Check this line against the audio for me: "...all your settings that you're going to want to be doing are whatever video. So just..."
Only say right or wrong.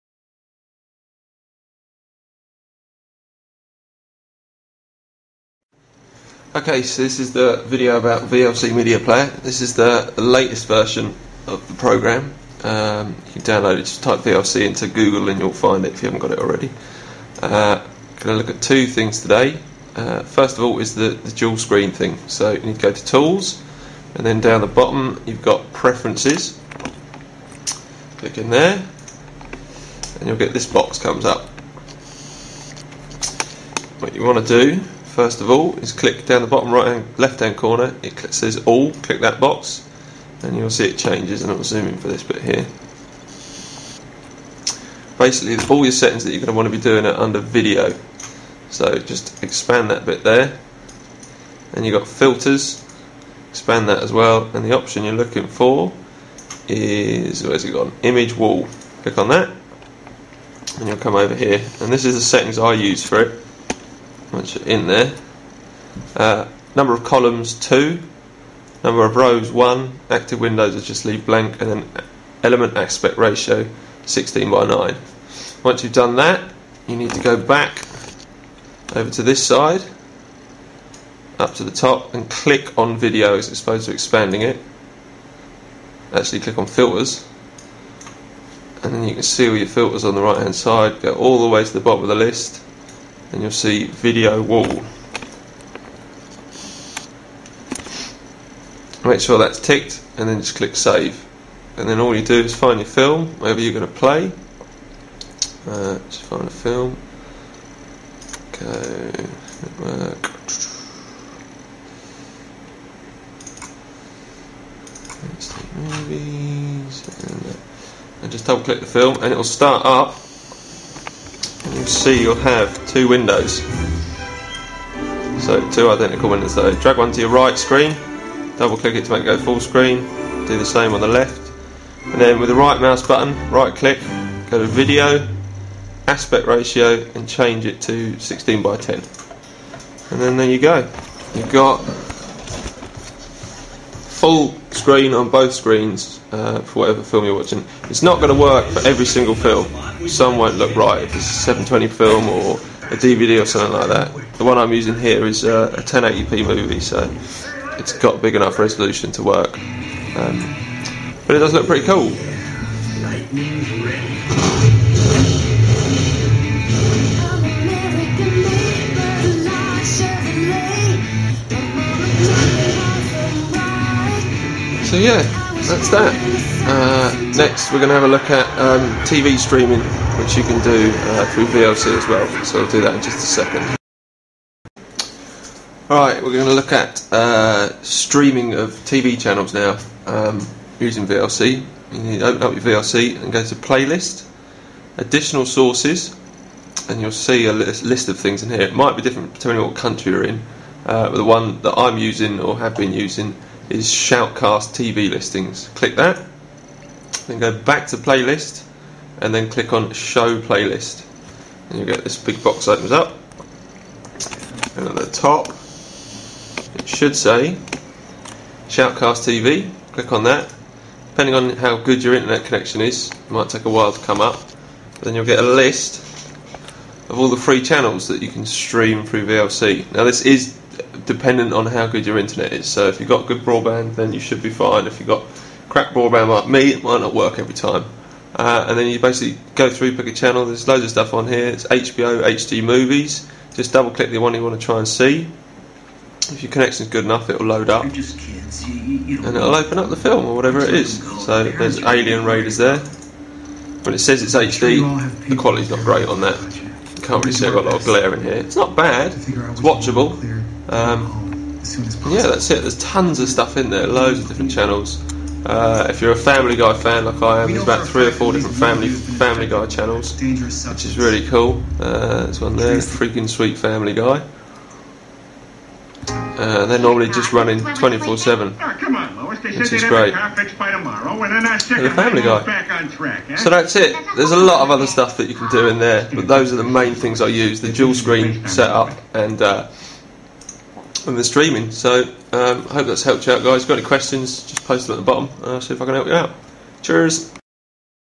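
wrong.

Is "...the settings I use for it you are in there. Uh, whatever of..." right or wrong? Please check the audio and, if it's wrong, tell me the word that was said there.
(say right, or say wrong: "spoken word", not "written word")
wrong: "number", not "whatever".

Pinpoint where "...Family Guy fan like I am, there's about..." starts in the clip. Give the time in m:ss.
4:26.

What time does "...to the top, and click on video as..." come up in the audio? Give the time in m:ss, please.
1:21.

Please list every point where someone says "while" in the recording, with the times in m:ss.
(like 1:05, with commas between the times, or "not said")
3:43.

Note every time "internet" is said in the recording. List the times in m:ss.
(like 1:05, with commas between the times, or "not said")
3:42, 3:52.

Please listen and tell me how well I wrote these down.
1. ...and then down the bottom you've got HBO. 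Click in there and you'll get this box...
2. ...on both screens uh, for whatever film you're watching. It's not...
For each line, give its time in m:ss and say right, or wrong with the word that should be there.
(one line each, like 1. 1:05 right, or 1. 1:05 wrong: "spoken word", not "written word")
1. 0:24 wrong: "Preferences", not "HBO"
2. 2:25 right.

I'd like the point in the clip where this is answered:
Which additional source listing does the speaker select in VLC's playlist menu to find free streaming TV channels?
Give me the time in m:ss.
3:23.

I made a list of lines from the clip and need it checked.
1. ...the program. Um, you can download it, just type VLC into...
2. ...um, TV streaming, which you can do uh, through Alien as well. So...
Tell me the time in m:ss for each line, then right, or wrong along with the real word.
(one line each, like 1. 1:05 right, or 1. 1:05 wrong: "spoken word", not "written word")
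1. 0:11 right
2. 2:58 wrong: "VLC", not "Alien".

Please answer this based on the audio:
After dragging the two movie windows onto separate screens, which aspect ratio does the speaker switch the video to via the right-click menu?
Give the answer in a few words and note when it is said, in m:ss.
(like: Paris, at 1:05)
16 by 10, at 2:18.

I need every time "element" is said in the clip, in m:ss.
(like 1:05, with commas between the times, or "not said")
1:12.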